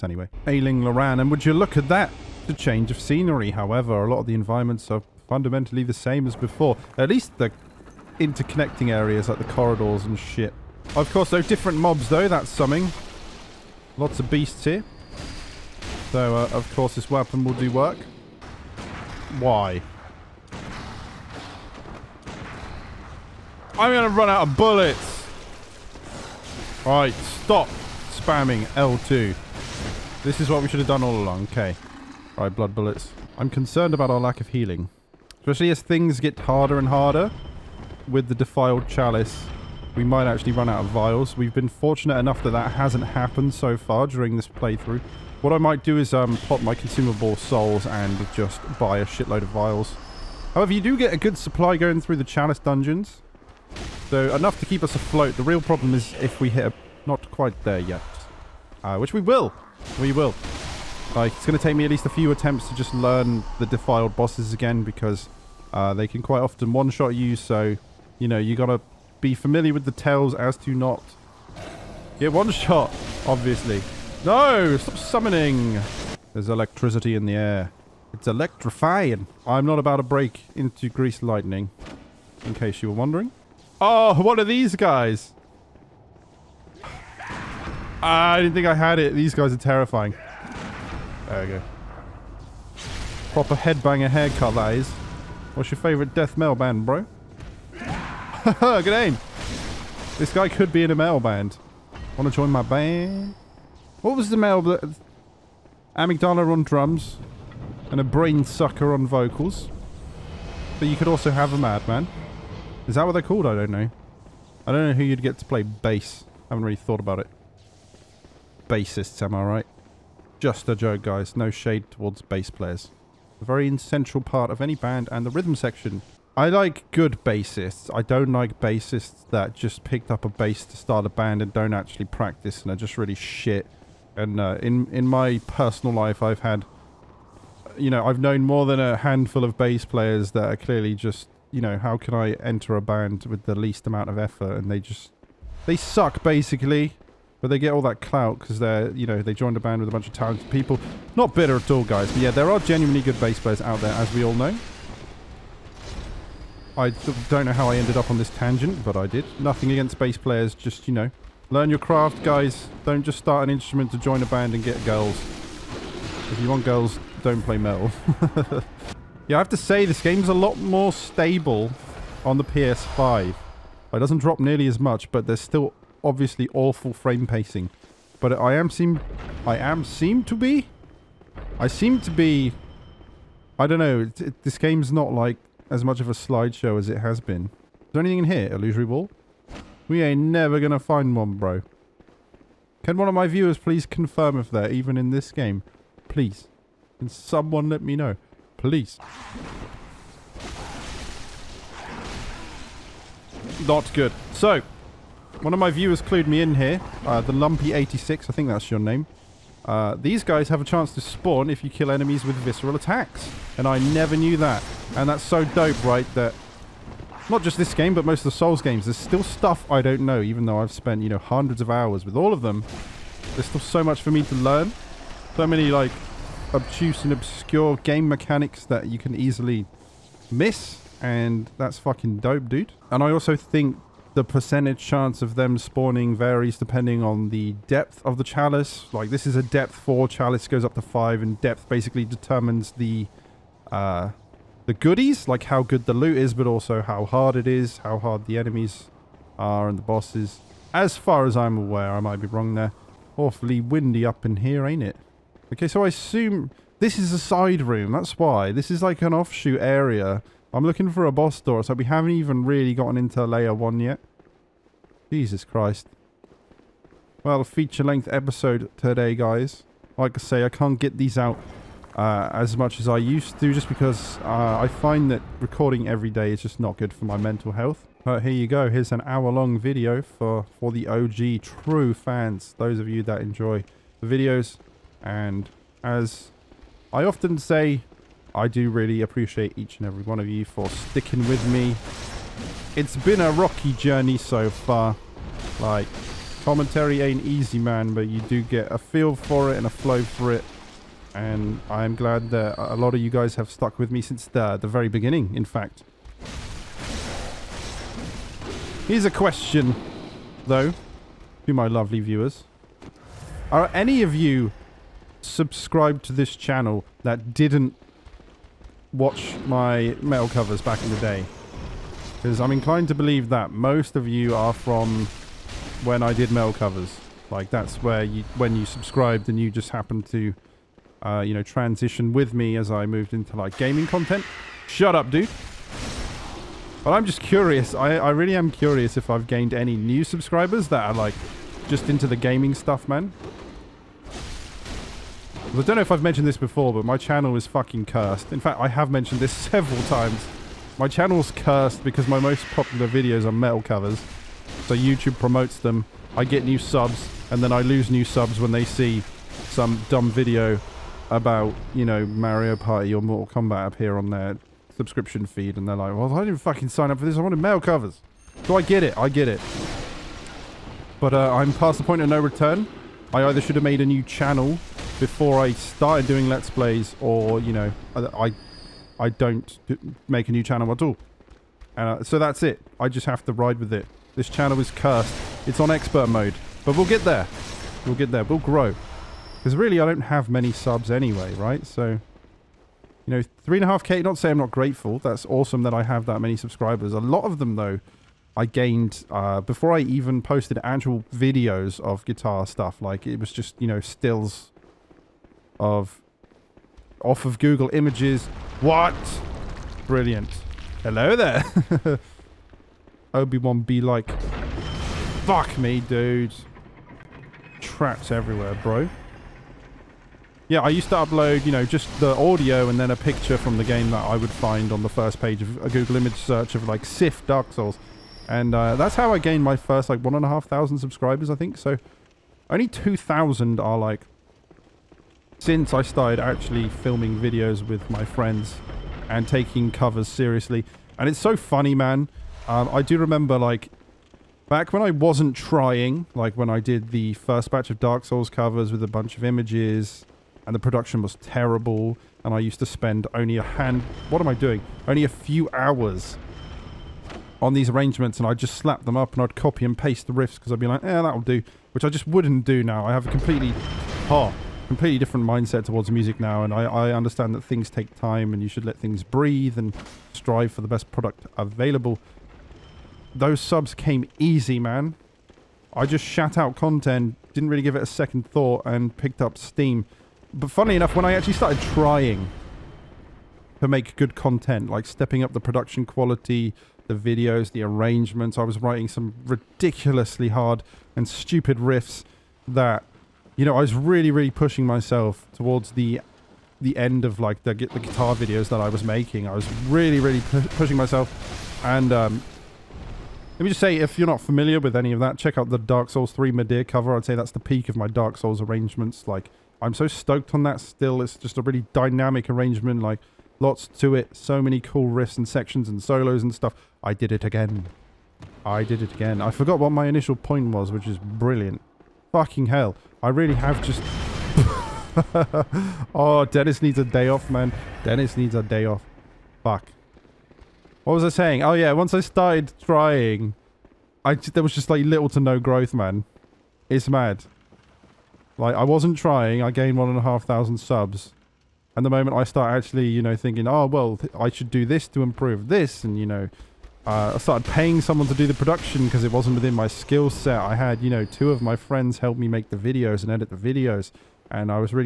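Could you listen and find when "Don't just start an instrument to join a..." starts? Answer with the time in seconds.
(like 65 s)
162 s.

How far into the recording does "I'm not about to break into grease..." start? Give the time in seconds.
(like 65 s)
79 s.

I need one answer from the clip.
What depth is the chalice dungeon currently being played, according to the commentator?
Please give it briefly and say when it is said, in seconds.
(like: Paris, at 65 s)
4, at 239 s.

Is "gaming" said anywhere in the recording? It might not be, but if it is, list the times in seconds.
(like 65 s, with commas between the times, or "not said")
333 s, 342 s.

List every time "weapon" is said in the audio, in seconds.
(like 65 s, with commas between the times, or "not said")
17 s.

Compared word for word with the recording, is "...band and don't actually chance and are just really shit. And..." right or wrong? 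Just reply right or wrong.
wrong.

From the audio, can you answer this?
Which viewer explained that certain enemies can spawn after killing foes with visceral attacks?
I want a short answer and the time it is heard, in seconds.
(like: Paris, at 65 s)
Lumpy86, at 207 s.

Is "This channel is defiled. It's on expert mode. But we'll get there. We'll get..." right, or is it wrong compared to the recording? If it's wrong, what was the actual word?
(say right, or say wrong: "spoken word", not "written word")
wrong: "cursed", not "defiled".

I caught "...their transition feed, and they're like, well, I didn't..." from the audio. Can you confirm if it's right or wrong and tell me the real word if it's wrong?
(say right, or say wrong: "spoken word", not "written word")
wrong: "subscription", not "transition".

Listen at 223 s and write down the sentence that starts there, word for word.
There's still so much for me to learn.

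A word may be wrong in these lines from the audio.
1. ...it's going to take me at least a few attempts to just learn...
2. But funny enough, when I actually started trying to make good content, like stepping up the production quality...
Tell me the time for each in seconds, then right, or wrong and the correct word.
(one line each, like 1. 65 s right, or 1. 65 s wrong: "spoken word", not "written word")
1. 61 s right
2. 480 s right.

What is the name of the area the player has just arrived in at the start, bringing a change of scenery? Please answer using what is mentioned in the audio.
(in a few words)
Ailing Loran.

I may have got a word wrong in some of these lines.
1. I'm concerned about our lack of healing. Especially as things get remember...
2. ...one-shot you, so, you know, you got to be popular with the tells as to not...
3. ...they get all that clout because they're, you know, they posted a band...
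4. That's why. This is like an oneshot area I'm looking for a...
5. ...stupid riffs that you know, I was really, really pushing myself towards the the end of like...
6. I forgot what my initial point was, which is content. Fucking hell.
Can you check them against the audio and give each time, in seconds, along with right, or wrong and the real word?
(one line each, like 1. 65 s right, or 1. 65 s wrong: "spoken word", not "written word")
1. 33 s wrong: "harder", not "remember"
2. 66 s wrong: "familiar", not "popular"
3. 147 s wrong: "joined", not "posted"
4. 257 s wrong: "offshoot", not "oneshot"
5. 491 s right
6. 519 s wrong: "brilliant", not "content".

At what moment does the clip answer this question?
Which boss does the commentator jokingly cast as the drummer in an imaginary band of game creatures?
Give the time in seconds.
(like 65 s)
105 s.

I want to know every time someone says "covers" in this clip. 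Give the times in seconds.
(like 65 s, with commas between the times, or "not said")
320 s, 326 s, 353 s, 367 s, 439 s, 448 s, 506 s.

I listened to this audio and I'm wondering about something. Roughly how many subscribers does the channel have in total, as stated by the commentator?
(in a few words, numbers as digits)
3.5k.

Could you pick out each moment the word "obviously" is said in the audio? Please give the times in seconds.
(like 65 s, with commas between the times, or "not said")
73 s, 176 s.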